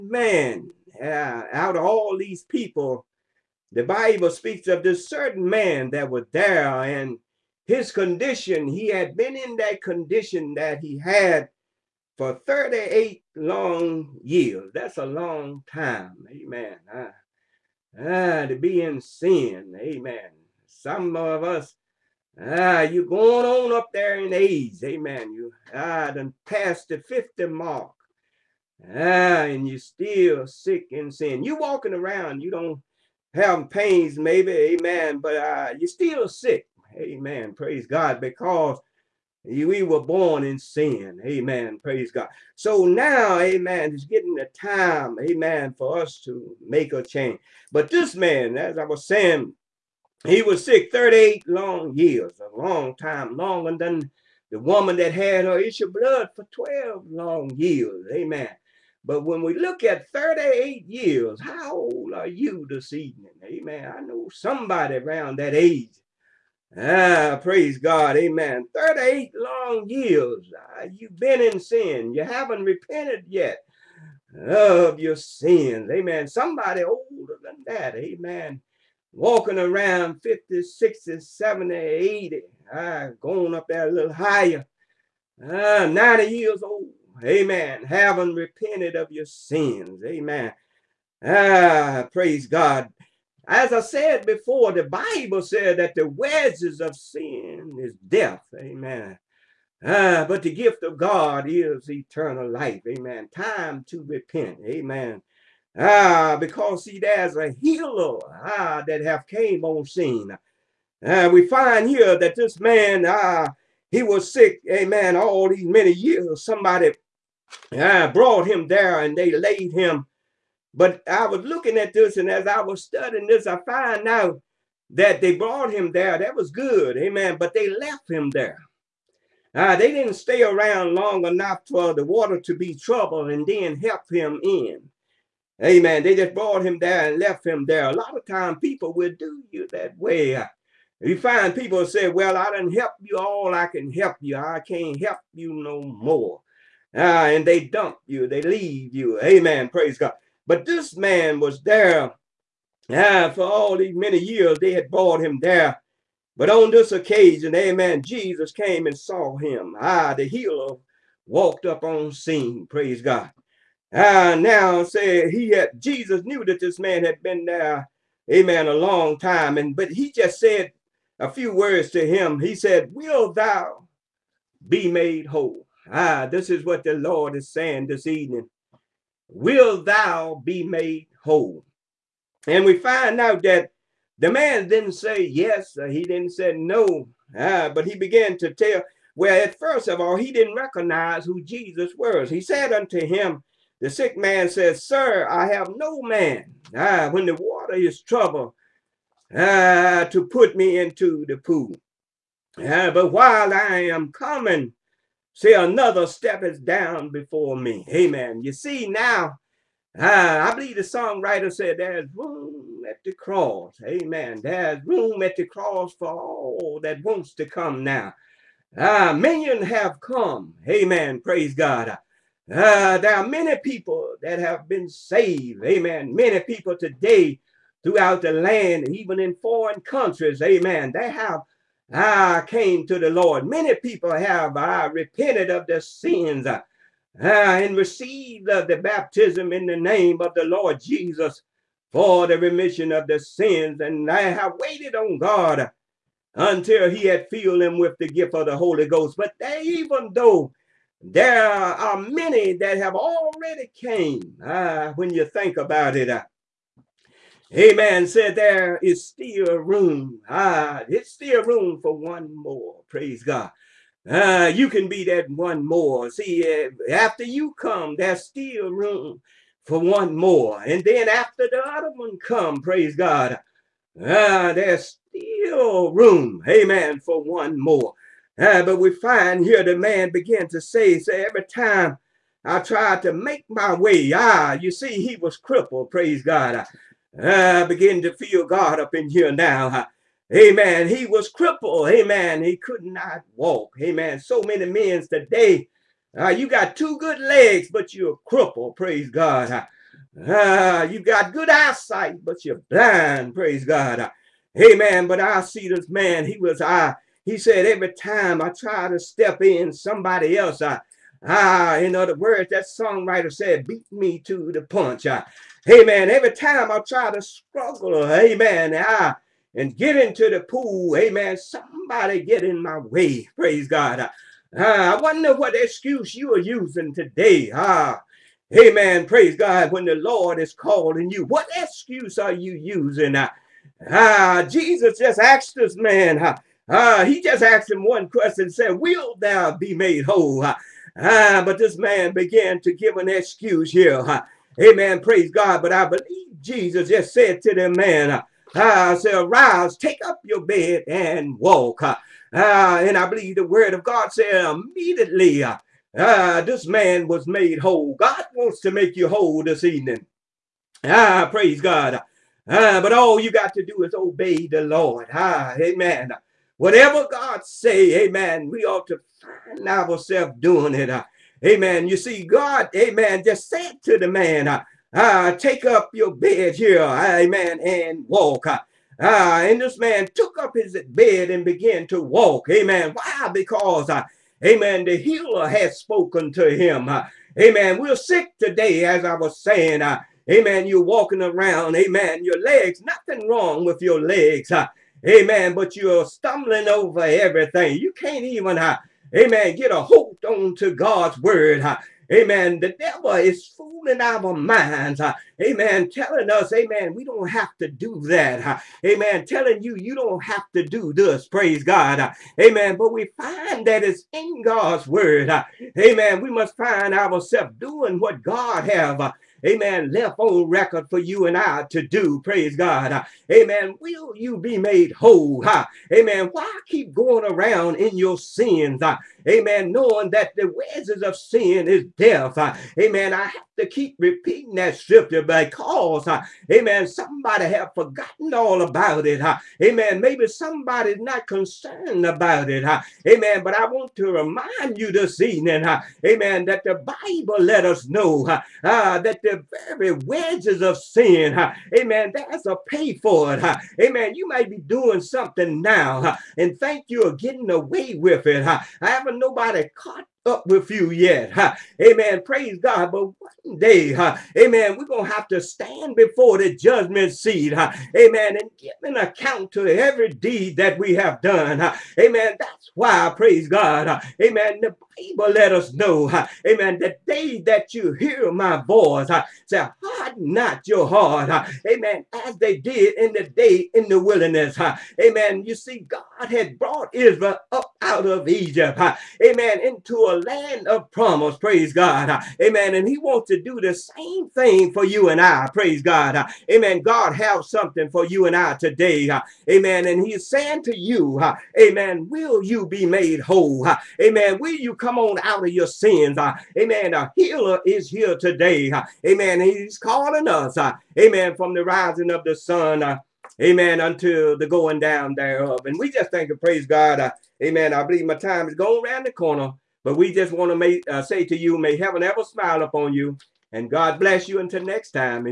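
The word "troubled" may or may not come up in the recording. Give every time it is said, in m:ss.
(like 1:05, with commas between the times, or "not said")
2:12, 3:18.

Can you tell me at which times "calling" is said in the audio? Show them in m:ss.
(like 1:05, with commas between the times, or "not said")
5:30, 8:29.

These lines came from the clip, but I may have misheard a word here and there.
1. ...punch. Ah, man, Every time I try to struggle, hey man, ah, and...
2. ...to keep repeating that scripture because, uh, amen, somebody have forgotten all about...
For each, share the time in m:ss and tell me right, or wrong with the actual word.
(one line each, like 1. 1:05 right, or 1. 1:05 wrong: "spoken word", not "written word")
1. 5:14 right
2. 7:13 right.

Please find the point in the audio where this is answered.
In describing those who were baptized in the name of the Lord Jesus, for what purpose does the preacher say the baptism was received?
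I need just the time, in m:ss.
4:02.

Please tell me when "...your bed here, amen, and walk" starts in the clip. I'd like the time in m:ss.
6:15.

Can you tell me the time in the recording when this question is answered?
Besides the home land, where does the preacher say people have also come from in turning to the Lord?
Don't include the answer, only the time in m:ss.
3:49.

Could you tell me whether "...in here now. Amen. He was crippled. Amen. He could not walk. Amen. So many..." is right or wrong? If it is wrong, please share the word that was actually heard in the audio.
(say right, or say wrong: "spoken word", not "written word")
right.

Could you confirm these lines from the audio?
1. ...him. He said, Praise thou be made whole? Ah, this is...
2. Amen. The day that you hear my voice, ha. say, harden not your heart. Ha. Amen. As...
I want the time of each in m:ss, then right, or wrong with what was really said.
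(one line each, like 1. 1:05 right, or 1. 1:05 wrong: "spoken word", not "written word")
1. 2:52 wrong: "Will", not "Praise"
2. 7:56 right.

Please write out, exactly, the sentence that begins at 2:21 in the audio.
You find people say, well, I didn't help you all I can help you.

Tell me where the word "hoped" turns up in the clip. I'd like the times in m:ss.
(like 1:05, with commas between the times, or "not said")
not said.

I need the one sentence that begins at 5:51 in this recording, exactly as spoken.
Uh, and I believe the word of God said immediately, uh, This man was made whole.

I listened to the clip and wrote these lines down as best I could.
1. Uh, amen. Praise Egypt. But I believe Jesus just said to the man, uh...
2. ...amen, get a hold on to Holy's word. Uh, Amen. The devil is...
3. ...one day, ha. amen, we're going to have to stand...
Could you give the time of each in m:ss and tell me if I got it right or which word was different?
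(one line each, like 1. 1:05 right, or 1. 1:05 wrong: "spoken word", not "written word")
1. 5:43 wrong: "God", not "Egypt"
2. 6:39 wrong: "God", not "Holy"
3. 7:43 right.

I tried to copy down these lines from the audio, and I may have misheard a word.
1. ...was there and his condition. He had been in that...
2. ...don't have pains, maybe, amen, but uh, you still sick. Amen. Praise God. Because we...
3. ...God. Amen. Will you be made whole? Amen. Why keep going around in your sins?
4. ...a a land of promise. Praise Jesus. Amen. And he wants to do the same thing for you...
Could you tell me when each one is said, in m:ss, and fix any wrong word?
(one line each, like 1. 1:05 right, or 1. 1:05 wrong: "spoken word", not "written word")
1. 0:06 right
2. 0:32 right
3. 7:02 right
4. 8:10 wrong: "God", not "Jesus".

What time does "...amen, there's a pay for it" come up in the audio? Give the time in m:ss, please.
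7:31.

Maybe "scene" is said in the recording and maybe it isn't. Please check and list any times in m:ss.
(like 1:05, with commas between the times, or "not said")
1:49, 2:42.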